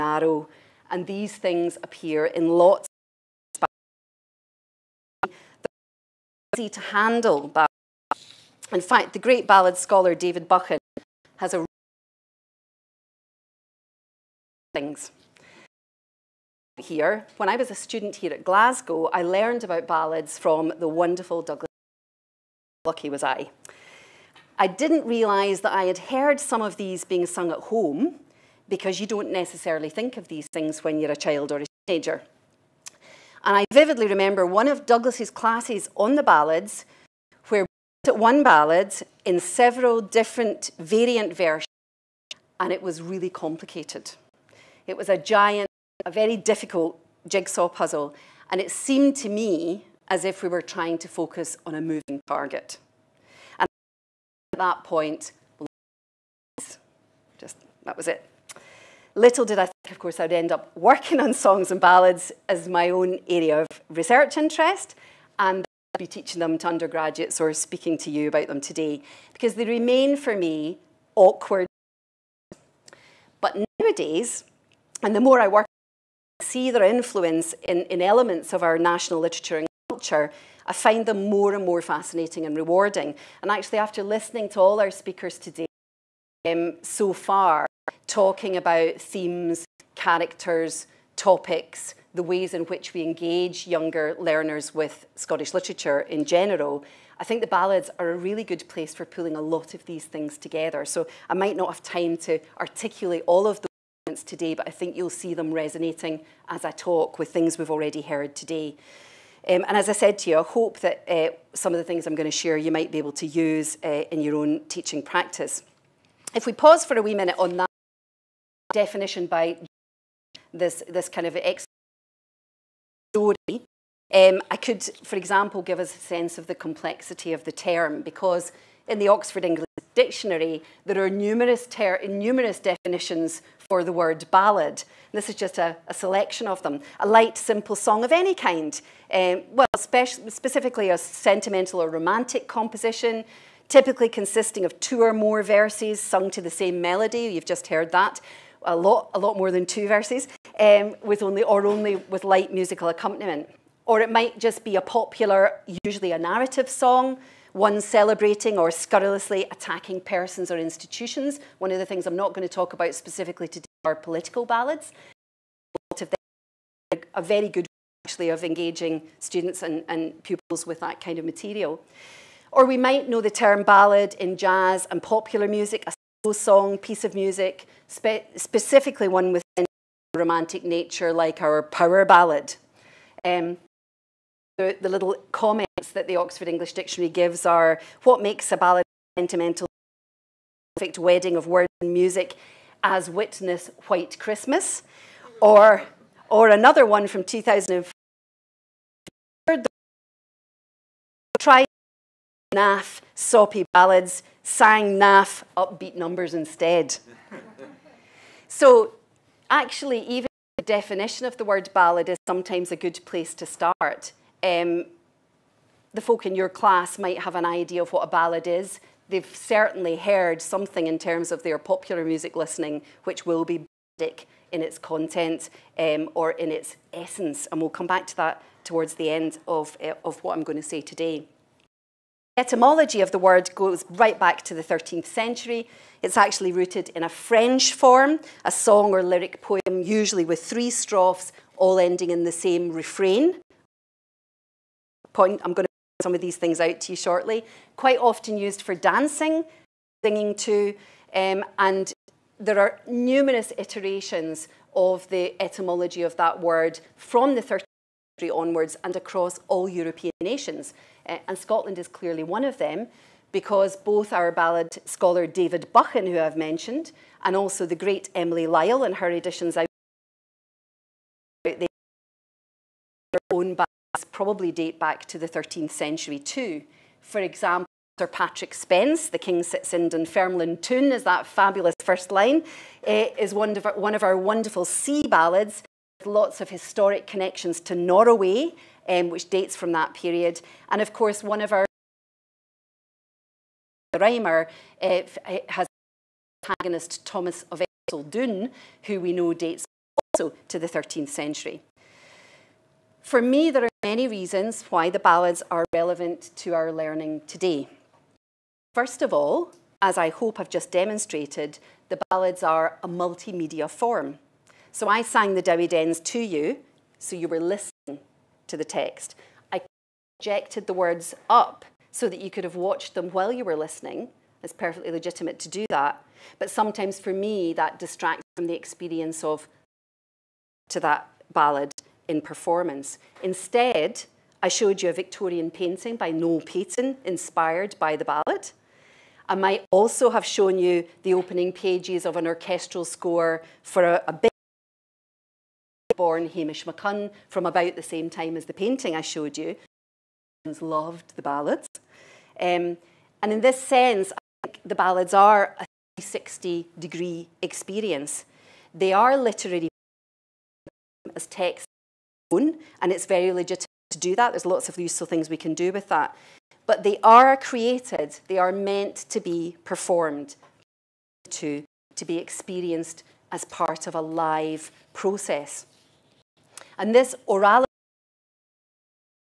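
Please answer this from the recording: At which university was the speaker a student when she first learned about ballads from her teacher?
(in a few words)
Glasgow.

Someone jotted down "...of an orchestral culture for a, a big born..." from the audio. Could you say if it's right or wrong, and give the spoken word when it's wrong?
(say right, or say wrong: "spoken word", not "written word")
wrong: "score", not "culture".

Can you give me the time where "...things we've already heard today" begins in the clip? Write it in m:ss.
1:47.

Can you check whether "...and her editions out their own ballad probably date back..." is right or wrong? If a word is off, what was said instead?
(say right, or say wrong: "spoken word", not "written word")
right.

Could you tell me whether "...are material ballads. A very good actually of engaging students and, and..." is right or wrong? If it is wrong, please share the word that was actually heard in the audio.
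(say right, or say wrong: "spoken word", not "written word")
wrong: "political", not "material".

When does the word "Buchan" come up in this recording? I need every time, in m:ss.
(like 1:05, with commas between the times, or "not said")
0:10, 4:25.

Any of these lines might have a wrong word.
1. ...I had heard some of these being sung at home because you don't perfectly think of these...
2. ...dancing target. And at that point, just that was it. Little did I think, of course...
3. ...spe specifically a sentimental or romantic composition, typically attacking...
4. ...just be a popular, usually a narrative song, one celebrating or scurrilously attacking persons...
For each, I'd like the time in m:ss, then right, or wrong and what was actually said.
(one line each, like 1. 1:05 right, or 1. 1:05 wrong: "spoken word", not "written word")
1. 0:25 wrong: "necessarily", not "perfectly"
2. 0:51 wrong: "moving", not "dancing"
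3. 2:19 wrong: "consisting", not "attacking"
4. 2:34 right.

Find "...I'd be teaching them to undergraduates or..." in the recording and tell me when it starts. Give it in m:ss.
1:05.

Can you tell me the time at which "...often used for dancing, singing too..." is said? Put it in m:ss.
4:07.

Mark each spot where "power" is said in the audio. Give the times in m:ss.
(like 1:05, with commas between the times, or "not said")
3:01.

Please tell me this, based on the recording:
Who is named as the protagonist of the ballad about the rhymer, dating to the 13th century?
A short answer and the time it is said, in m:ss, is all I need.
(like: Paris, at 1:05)
Thomas of Erceldoune, at 4:57.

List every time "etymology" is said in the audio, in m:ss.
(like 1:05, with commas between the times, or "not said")
3:52, 4:15.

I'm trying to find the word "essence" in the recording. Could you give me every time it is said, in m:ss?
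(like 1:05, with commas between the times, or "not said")
3:46.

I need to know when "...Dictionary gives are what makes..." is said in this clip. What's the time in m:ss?
3:06.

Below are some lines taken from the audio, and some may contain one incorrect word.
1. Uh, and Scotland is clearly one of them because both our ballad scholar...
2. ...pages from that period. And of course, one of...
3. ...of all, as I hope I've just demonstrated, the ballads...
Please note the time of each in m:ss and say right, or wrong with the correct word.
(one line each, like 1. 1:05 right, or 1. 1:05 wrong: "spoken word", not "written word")
1. 4:21 right
2. 4:49 wrong: "dates", not "pages"
3. 5:09 right.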